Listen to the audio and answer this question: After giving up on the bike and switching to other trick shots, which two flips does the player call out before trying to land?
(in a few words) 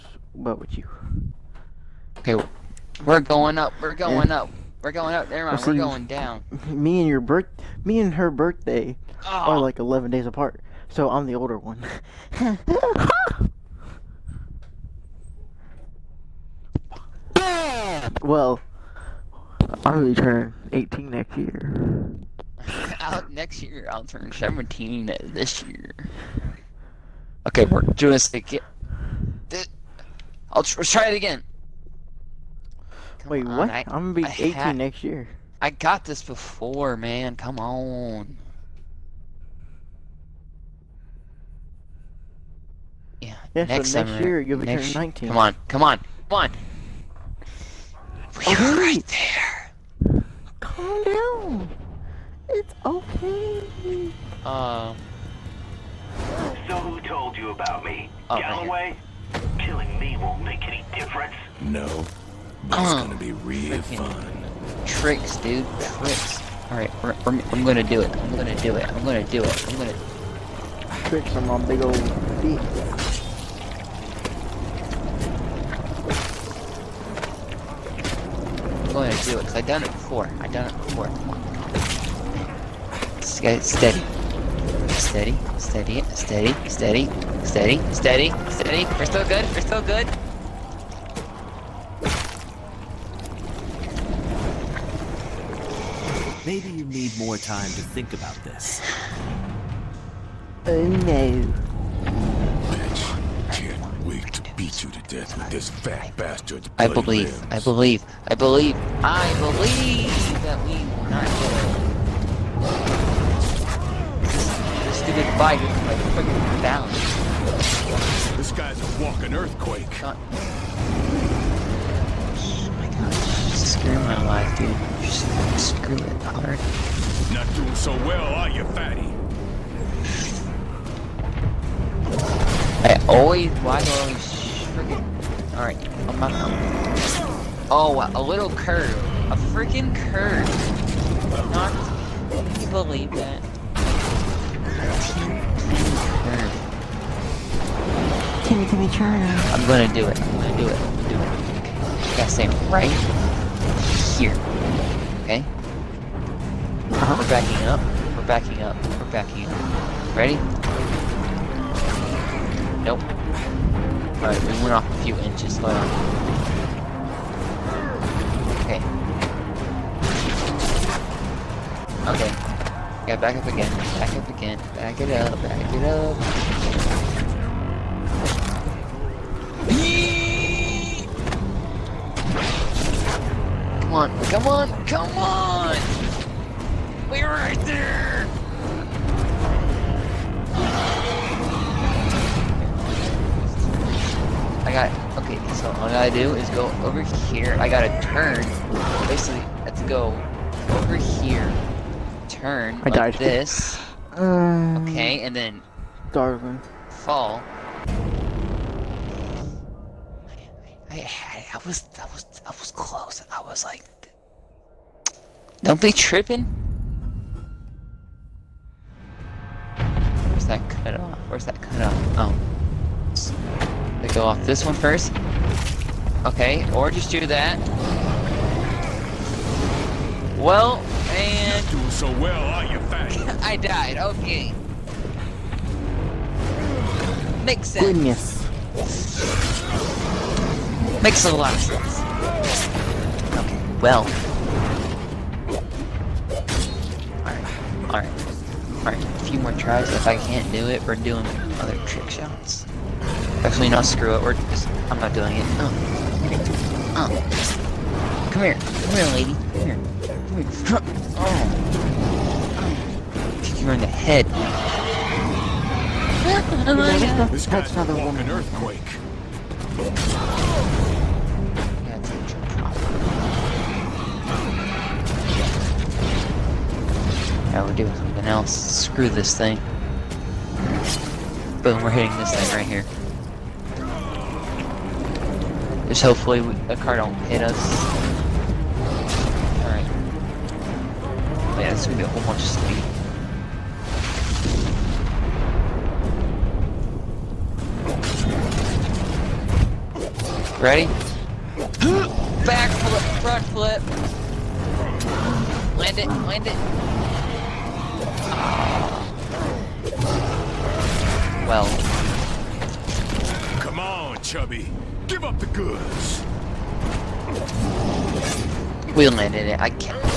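Back flip, front flip.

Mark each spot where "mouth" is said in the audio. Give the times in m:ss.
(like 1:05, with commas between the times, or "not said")
not said.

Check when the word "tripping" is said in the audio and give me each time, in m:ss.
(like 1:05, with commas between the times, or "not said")
3:35.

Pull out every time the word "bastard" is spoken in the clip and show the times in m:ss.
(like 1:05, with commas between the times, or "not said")
1:46.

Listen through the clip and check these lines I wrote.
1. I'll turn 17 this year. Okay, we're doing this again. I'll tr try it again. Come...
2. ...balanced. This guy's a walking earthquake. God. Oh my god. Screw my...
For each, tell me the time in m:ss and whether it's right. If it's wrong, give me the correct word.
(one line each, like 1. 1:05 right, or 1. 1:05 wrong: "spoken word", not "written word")
1. 0:23 right
2. 1:56 right.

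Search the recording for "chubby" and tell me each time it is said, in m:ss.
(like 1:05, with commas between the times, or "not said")
5:14.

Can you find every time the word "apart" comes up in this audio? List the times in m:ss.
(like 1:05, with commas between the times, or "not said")
0:10.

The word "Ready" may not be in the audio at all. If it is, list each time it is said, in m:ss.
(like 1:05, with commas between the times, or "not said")
2:40, 5:00.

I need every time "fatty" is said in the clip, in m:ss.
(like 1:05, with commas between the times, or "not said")
2:08.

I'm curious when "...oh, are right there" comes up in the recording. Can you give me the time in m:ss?
0:48.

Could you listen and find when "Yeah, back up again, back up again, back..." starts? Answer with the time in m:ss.
2:53.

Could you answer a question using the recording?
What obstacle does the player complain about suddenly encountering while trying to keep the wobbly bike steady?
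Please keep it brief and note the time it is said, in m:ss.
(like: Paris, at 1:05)
a little curve, at 2:18.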